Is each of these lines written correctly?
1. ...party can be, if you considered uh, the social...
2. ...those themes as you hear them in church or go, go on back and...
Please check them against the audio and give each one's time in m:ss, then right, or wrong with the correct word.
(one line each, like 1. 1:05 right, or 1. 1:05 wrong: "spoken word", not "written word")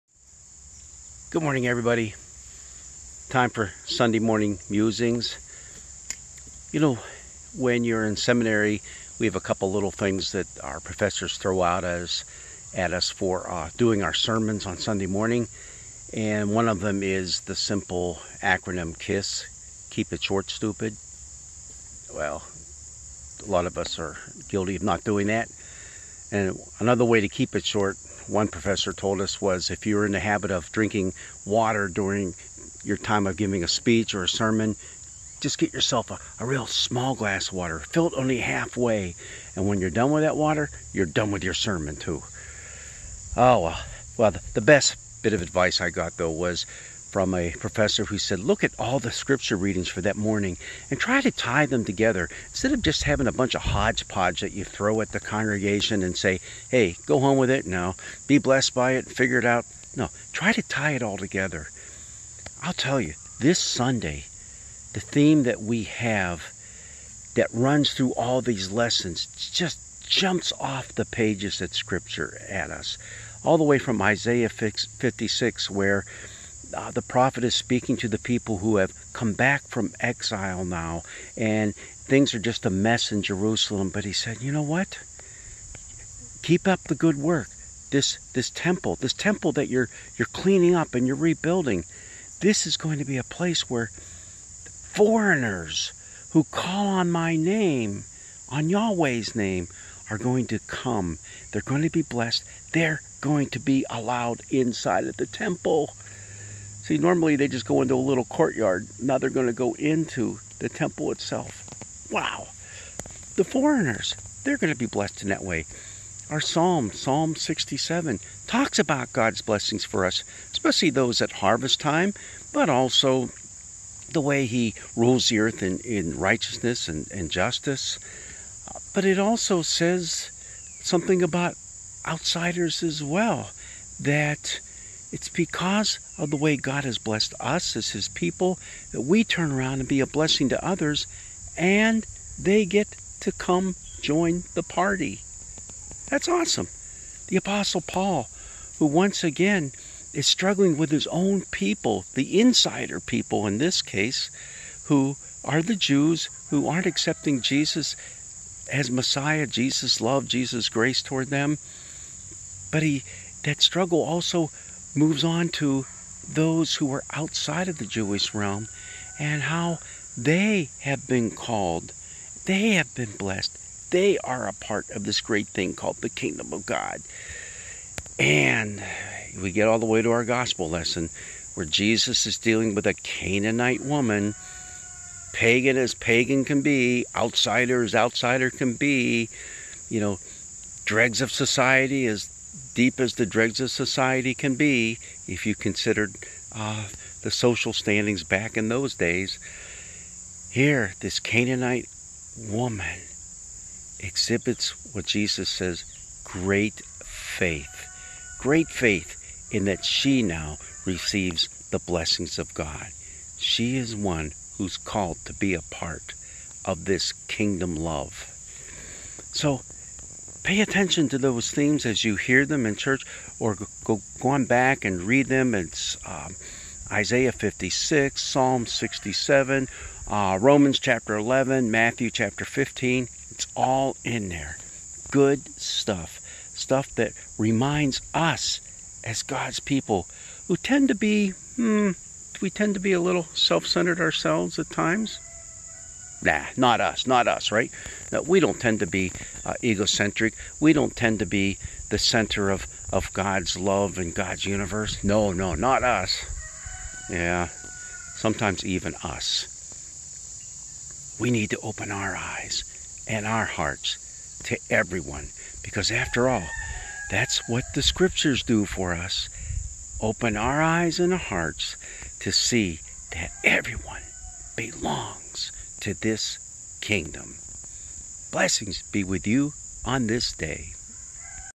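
1. 3:13 wrong: "society", not "party"
2. 3:41 right.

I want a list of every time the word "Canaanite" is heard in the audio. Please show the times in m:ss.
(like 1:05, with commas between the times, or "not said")
3:02, 3:21.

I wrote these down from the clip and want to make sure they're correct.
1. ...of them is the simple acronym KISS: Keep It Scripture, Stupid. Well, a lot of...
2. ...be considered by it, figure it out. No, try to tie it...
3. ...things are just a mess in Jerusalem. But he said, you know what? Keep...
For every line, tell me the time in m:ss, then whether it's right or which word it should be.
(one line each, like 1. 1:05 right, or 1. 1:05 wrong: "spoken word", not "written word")
1. 0:16 wrong: "Short", not "Scripture"
2. 0:58 wrong: "blessed", not "considered"
3. 1:21 right.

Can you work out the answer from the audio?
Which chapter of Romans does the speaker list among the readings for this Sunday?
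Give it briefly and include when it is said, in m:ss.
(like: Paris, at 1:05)
11, at 3:50.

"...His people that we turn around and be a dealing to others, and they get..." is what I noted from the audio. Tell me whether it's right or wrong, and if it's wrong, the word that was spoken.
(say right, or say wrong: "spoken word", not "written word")
wrong: "blessing", not "dealing".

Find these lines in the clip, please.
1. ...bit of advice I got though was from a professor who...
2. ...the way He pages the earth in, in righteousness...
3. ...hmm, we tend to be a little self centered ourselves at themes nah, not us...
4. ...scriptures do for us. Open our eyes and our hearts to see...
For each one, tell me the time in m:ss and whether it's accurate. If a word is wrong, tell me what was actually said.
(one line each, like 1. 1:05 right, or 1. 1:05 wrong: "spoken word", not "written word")
1. 0:45 right
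2. 2:04 wrong: "rules", not "pages"
3. 4:01 wrong: "times", not "themes"
4. 4:27 right.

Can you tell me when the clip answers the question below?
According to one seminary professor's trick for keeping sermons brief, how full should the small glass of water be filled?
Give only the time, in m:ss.
0:37.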